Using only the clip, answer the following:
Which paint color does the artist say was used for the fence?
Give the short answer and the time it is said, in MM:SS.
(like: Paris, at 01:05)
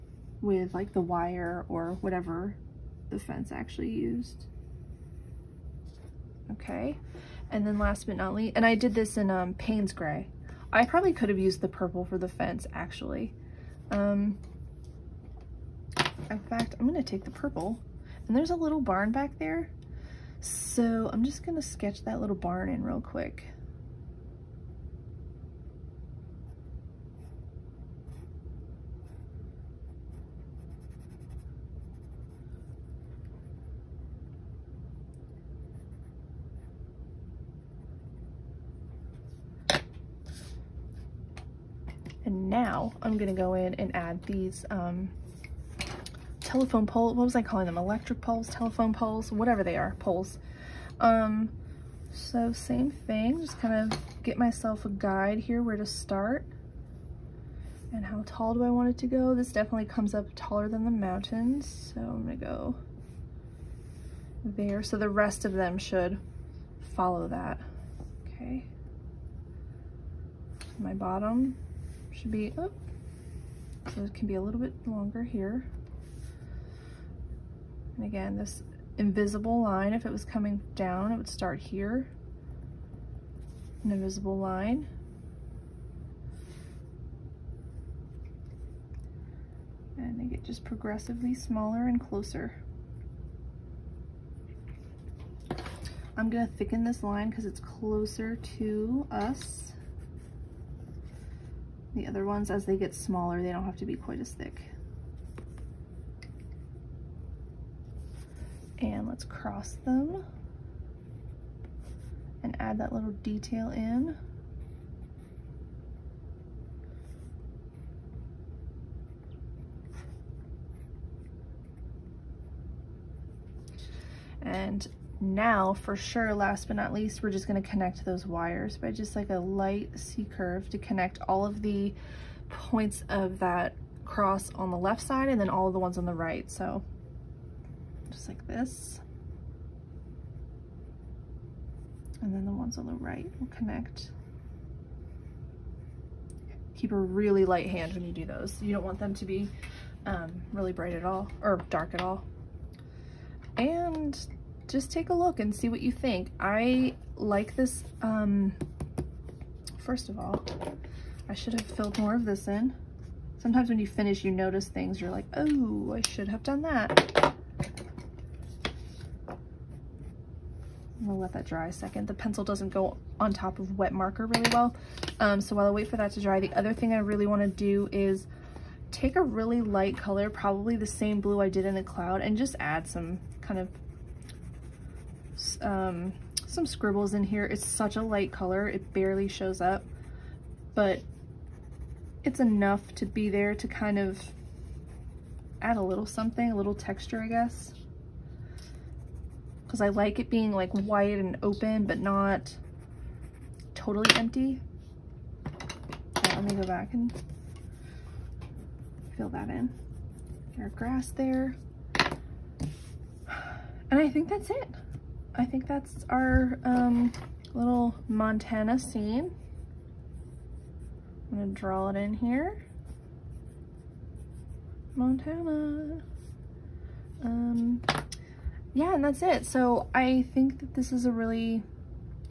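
Payne's Gray, at 00:09.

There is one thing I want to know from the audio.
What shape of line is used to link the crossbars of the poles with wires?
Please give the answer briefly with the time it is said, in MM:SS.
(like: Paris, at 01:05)
C curve, at 02:09.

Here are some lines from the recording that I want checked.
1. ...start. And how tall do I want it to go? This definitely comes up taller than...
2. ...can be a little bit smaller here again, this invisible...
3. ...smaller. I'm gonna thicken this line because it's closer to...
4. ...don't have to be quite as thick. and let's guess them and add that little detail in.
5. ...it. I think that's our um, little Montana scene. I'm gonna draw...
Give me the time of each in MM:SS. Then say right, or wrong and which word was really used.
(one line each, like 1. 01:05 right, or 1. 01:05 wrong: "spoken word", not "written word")
1. 00:55 right
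2. 01:14 wrong: "longer", not "smaller"
3. 01:31 wrong: "closer", not "smaller"
4. 01:43 wrong: "cross", not "guess"
5. 03:34 right.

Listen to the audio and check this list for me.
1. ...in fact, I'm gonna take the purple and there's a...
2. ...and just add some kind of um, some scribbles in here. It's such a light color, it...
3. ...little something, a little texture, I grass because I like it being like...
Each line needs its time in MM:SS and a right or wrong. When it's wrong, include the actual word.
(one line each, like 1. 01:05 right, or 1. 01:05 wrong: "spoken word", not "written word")
1. 00:16 right
2. 03:02 right
3. 03:15 wrong: "guess", not "grass".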